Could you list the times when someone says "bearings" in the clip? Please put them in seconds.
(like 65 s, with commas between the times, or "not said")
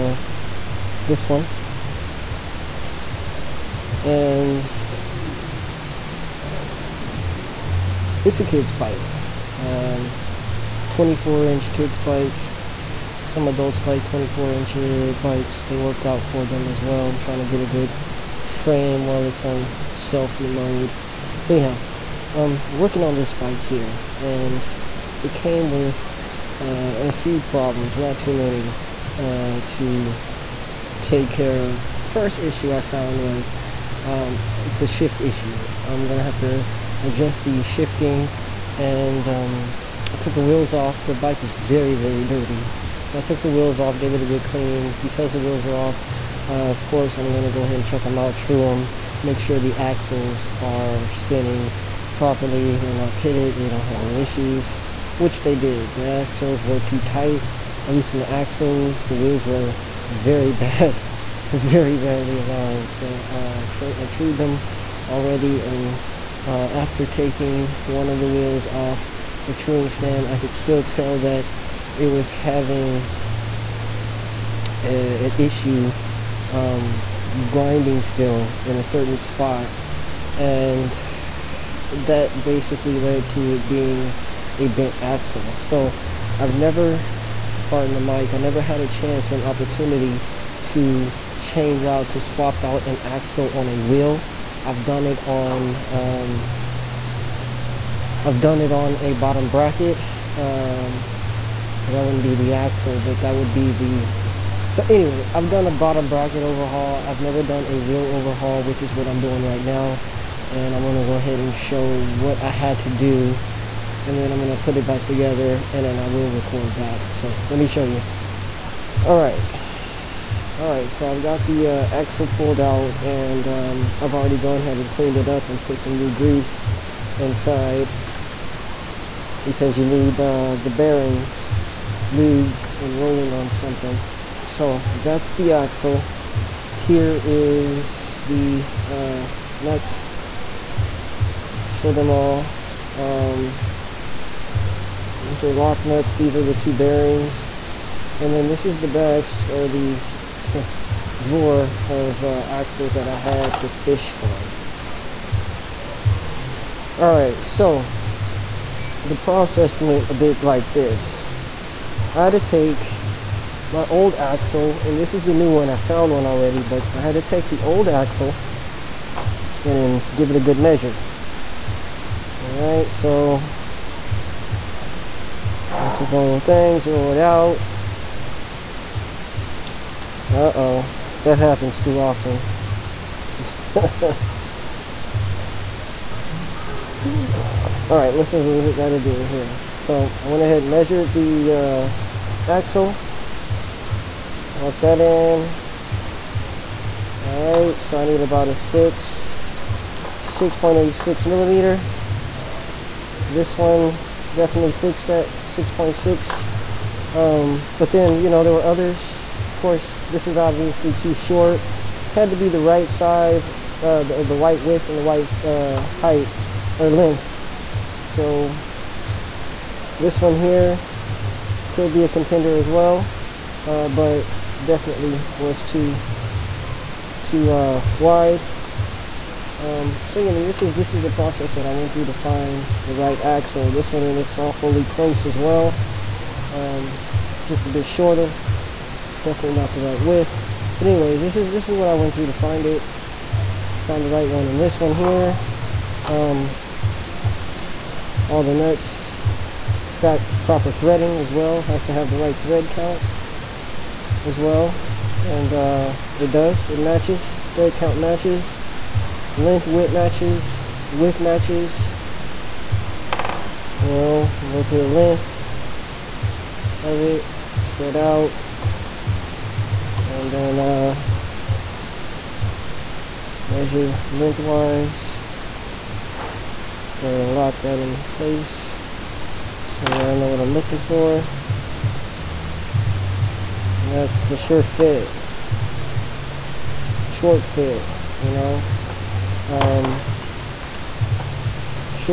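130 s, 146 s.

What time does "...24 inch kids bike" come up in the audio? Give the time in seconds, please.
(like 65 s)
10 s.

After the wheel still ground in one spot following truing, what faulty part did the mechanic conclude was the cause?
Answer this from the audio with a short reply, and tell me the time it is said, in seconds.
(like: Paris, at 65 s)
bent axle, at 84 s.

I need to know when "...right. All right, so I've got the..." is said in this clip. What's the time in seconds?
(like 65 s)
119 s.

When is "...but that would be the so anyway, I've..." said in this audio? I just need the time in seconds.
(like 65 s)
103 s.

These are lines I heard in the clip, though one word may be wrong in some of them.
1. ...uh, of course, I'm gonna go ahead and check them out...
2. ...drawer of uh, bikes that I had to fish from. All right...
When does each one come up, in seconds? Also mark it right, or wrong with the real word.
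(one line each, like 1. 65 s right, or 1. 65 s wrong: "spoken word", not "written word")
1. 46 s right
2. 151 s wrong: "axles", not "bikes".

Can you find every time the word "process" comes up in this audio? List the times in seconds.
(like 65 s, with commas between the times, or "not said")
159 s, 231 s.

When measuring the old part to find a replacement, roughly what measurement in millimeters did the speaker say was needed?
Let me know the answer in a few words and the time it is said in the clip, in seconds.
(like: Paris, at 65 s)
6.86 millimeters, at 200 s.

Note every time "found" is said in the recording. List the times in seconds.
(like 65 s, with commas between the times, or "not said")
32 s, 165 s, 243 s.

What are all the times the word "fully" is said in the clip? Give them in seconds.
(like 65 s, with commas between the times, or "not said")
234 s.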